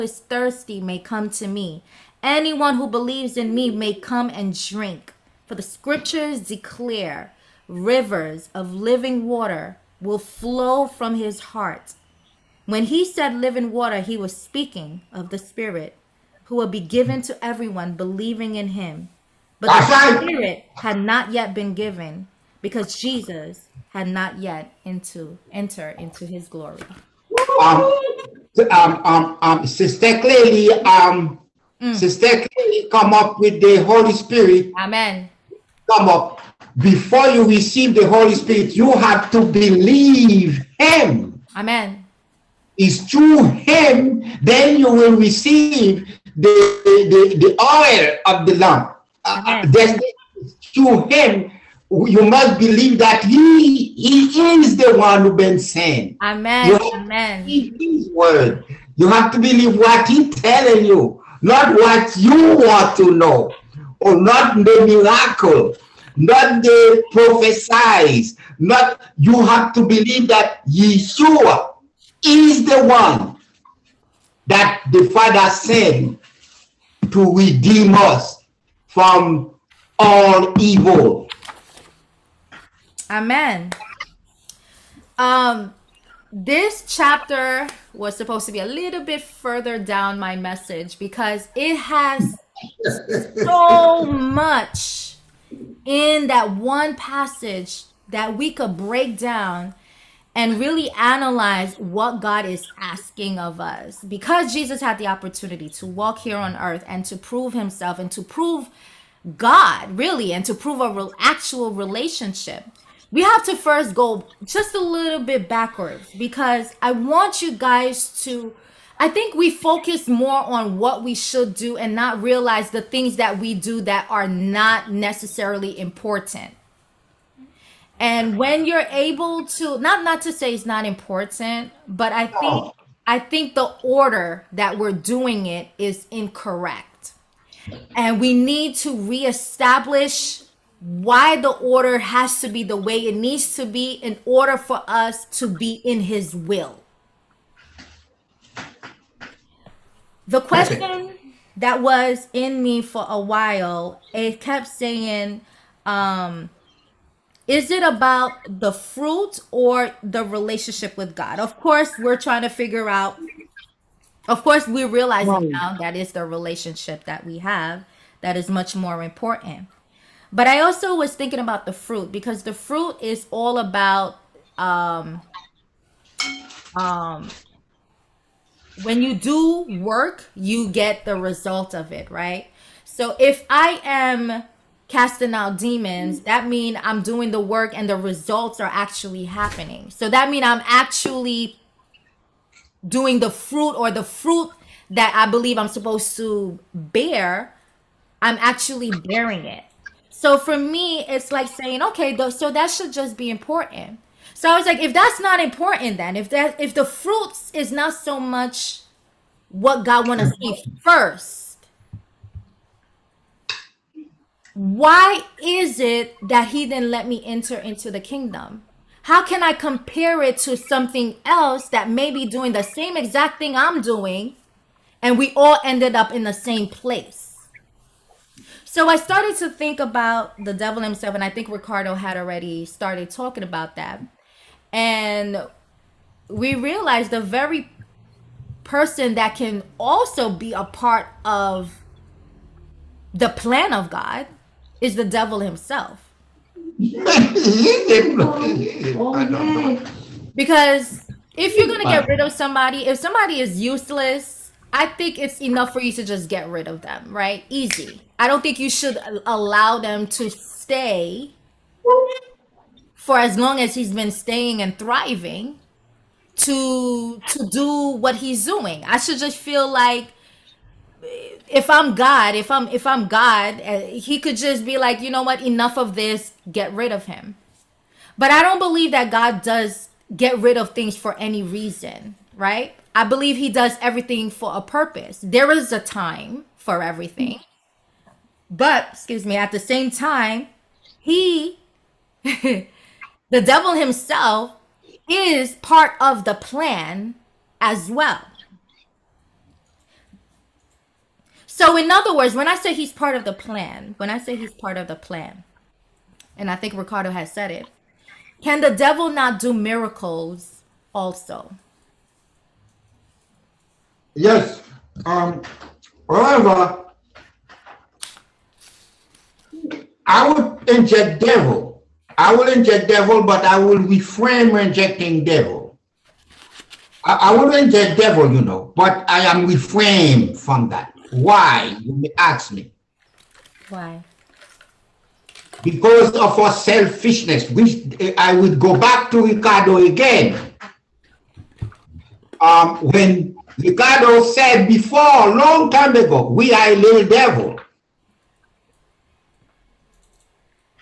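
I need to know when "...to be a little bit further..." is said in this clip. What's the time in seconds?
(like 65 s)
88 s.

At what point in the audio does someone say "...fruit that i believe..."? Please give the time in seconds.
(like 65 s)
194 s.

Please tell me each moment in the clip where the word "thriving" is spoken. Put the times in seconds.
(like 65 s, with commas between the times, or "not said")
264 s.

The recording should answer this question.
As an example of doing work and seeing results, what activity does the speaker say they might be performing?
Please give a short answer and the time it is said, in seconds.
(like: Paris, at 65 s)
casting out demons, at 184 s.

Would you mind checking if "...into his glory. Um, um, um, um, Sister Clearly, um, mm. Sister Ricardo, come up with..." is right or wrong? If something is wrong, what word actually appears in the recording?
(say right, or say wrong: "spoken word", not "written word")
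wrong: "Clearly", not "Ricardo".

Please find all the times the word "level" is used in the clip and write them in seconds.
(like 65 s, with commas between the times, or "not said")
not said.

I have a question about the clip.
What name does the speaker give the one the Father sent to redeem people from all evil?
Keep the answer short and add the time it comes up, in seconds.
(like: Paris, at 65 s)
Yeshua, at 70 s.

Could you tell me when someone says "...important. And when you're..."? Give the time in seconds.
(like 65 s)
125 s.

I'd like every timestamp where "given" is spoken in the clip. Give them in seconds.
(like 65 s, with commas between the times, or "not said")
16 s, 21 s.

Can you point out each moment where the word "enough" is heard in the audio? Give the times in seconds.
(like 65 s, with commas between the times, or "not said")
255 s, 275 s.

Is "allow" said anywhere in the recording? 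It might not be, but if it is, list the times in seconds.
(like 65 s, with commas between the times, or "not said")
259 s.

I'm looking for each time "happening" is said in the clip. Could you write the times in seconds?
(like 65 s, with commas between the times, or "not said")
189 s.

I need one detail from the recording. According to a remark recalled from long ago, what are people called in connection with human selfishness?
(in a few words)
a little devil.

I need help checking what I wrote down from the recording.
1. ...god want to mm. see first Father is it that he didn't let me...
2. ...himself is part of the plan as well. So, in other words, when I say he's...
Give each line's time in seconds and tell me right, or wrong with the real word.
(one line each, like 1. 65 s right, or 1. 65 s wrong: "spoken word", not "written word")
1. 209 s wrong: "Why", not "Father"
2. 293 s right.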